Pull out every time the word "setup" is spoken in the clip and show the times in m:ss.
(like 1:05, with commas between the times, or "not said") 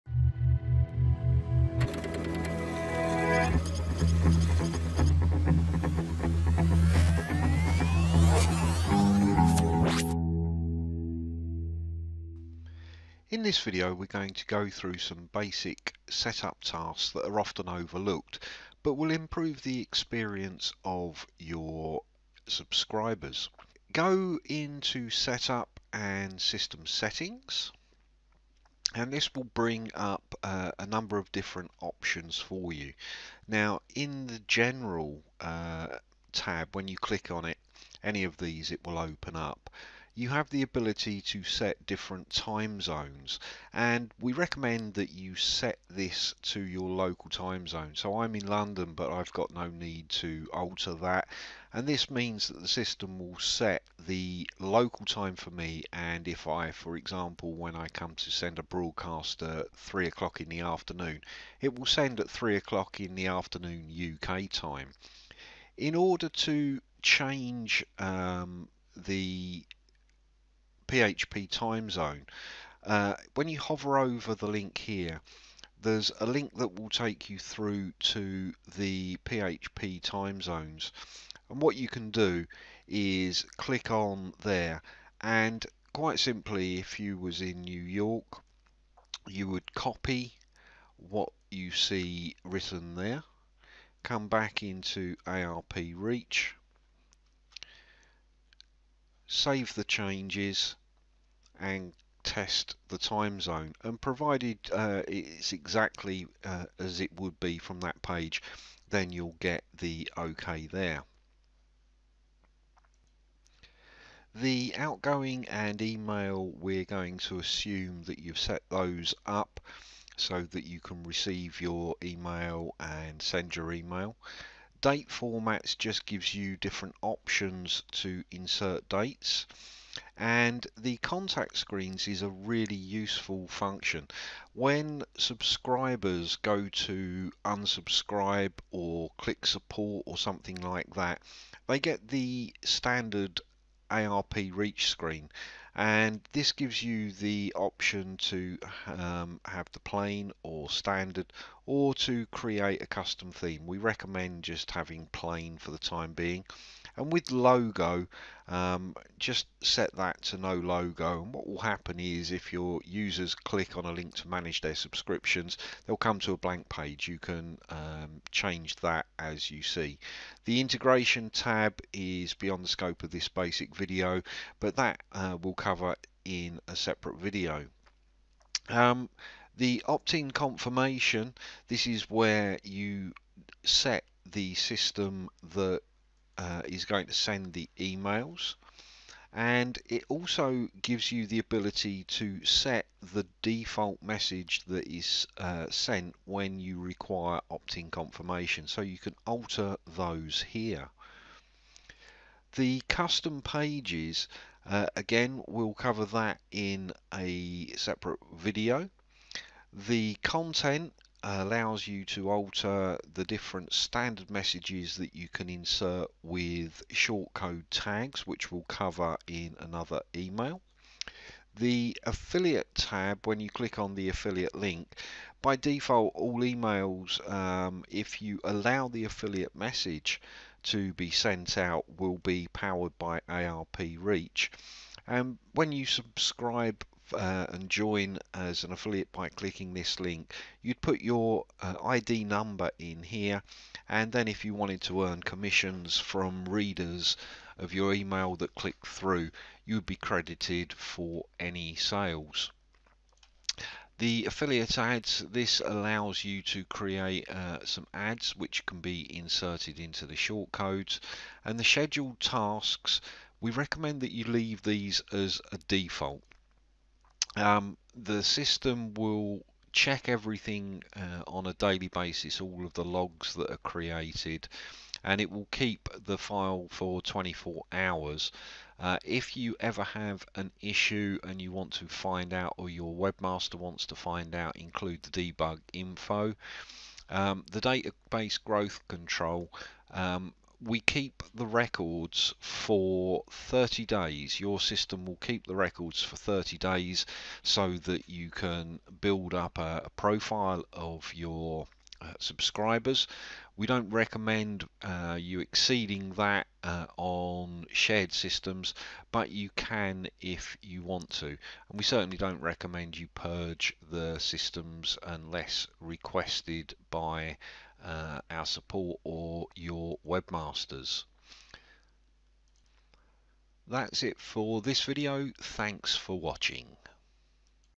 0:16, 0:25.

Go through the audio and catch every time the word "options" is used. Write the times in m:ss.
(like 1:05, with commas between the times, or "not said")
0:31, 2:07, 2:27.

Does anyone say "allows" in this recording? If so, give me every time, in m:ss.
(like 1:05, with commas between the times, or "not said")
3:31, 3:48, 4:15.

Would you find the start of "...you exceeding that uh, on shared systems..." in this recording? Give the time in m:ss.
5:05.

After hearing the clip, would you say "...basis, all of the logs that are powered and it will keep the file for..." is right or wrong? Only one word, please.
wrong.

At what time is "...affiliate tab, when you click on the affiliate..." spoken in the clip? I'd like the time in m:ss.
3:42.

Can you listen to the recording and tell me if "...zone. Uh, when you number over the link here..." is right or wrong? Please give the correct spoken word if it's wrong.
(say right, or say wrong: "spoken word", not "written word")
wrong: "hover", not "number".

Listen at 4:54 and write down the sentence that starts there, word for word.
Your system will keep the records for 30 days so that you can build up a, a profile of your uh, subscribers.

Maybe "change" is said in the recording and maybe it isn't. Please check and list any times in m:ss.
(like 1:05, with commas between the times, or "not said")
1:07, 1:39, 2:48.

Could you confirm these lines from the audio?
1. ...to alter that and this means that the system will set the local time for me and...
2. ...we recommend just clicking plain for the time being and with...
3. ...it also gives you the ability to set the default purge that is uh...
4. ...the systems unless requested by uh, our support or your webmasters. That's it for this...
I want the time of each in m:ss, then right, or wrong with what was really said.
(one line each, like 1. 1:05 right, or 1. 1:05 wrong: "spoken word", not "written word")
1. 0:50 right
2. 2:33 wrong: "having", not "clicking"
3. 3:09 wrong: "message", not "purge"
4. 5:13 right.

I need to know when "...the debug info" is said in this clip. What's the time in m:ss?
4:45.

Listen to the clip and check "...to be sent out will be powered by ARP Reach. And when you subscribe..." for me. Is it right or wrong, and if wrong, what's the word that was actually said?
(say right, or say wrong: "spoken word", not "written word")
right.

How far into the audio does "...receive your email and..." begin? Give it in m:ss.
2:01.